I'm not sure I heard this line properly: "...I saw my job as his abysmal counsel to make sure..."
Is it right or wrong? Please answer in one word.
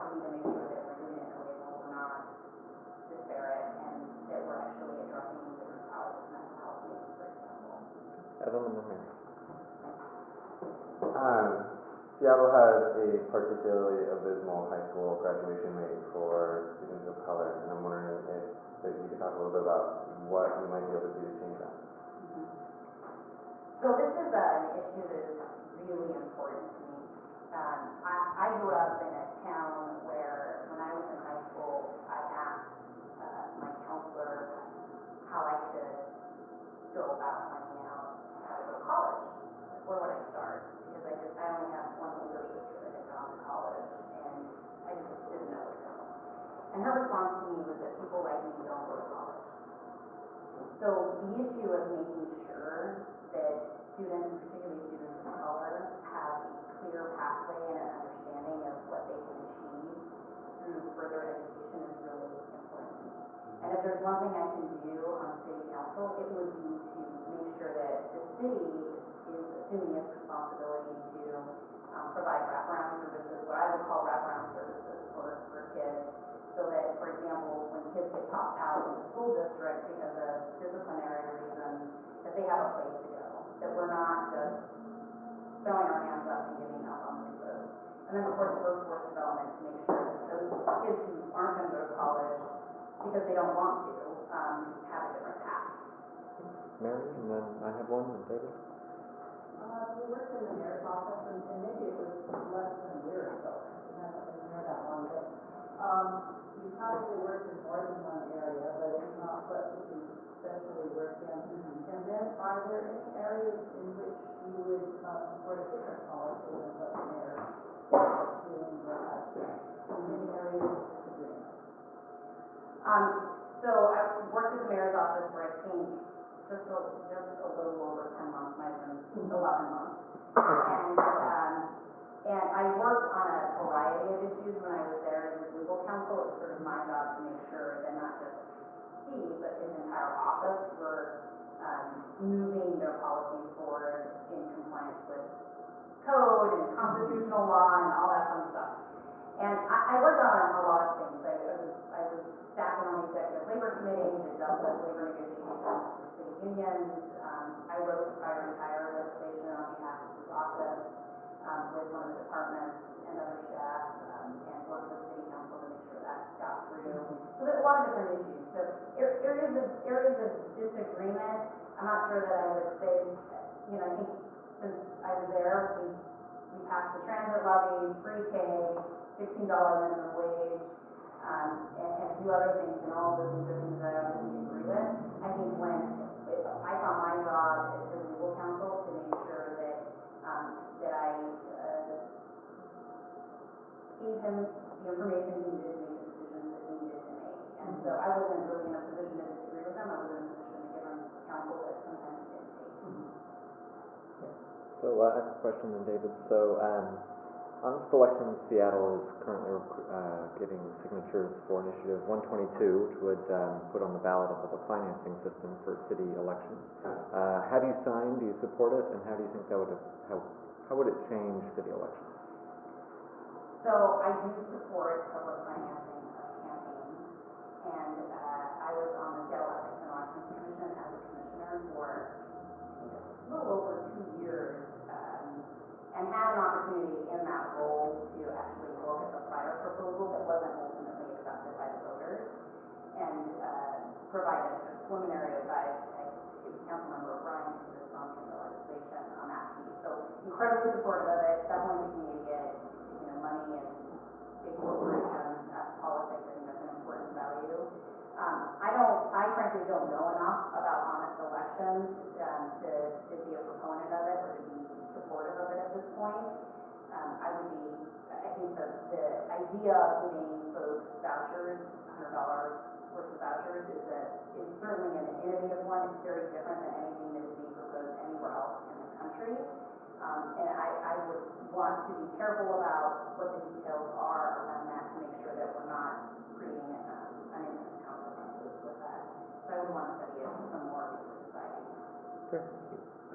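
wrong.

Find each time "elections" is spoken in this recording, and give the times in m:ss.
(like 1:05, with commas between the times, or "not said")
3:27, 3:36, 3:41, 4:21.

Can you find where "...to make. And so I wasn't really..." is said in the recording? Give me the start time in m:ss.
3:17.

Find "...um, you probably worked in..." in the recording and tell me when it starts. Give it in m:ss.
1:45.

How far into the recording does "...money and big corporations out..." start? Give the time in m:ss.
4:13.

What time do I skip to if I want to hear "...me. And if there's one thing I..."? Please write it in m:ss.
1:03.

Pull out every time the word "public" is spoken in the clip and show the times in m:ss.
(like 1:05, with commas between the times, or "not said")
3:34, 3:45.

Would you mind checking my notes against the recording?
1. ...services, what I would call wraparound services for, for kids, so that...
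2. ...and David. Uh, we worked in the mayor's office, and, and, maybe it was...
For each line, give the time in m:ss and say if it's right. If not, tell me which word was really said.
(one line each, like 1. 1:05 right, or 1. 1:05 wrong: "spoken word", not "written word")
1. 1:12 right
2. 1:38 right.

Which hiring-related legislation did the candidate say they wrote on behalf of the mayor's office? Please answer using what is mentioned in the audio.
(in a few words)
priority hire.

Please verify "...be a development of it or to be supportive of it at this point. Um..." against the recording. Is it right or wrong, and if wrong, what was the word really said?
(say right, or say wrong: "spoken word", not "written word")
wrong: "proponent", not "development".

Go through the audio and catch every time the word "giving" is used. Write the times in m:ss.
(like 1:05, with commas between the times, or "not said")
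1:26, 4:30.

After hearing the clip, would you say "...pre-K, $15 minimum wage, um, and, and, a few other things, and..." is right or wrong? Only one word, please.
right.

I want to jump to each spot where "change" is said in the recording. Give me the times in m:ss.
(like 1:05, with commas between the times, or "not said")
0:21, 3:40.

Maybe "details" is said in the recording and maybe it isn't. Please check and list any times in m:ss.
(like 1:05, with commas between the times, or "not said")
4:43.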